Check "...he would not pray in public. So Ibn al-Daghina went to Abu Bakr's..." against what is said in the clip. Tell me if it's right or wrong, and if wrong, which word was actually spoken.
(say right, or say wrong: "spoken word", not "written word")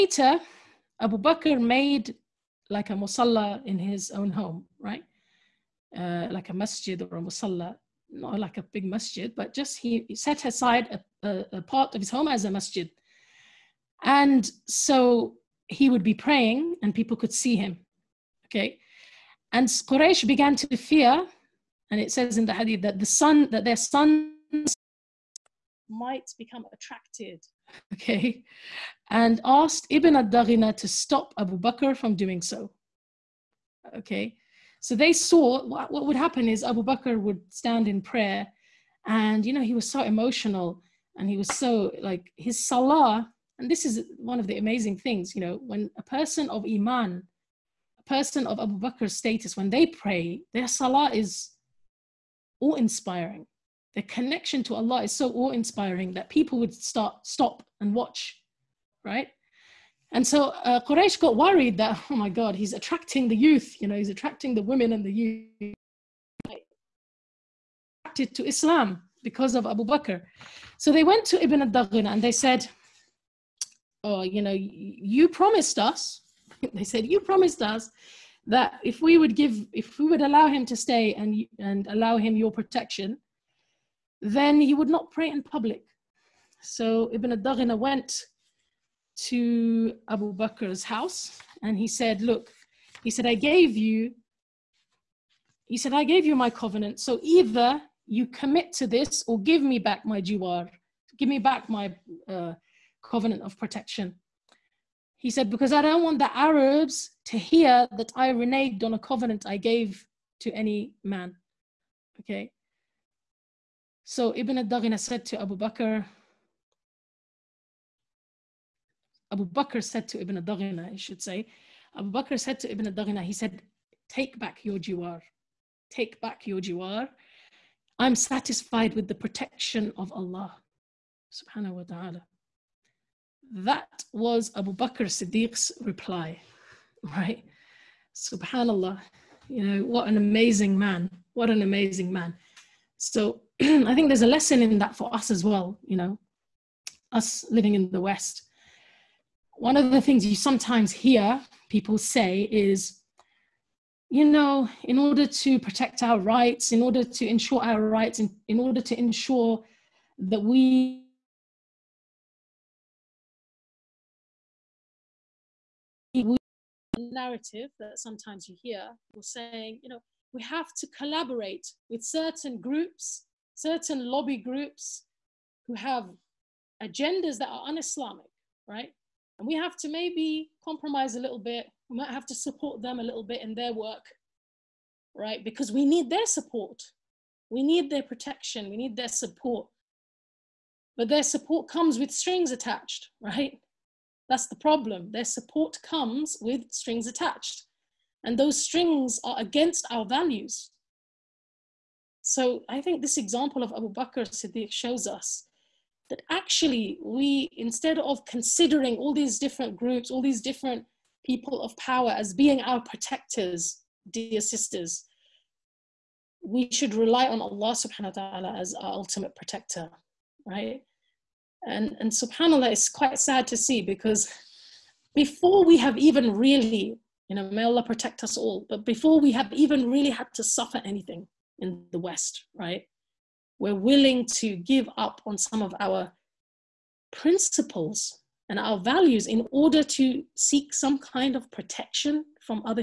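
right.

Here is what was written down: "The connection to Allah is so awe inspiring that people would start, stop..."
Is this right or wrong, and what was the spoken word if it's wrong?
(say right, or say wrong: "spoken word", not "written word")
right.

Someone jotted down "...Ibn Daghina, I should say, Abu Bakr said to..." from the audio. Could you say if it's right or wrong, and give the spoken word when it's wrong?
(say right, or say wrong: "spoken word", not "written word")
right.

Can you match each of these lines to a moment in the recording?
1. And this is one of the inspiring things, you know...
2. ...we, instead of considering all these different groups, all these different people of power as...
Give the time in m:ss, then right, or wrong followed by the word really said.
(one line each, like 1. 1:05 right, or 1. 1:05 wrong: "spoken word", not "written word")
1. 0:43 wrong: "amazing", not "inspiring"
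2. 3:27 right.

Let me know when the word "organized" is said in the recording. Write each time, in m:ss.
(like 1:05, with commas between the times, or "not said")
not said.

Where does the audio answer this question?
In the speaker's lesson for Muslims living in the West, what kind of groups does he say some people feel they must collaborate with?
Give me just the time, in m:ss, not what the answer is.
2:54.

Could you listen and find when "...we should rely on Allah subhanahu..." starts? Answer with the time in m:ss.
3:36.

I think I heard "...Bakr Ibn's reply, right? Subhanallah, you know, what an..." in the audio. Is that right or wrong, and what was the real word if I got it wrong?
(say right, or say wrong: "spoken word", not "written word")
wrong: "Siddiq", not "Ibn".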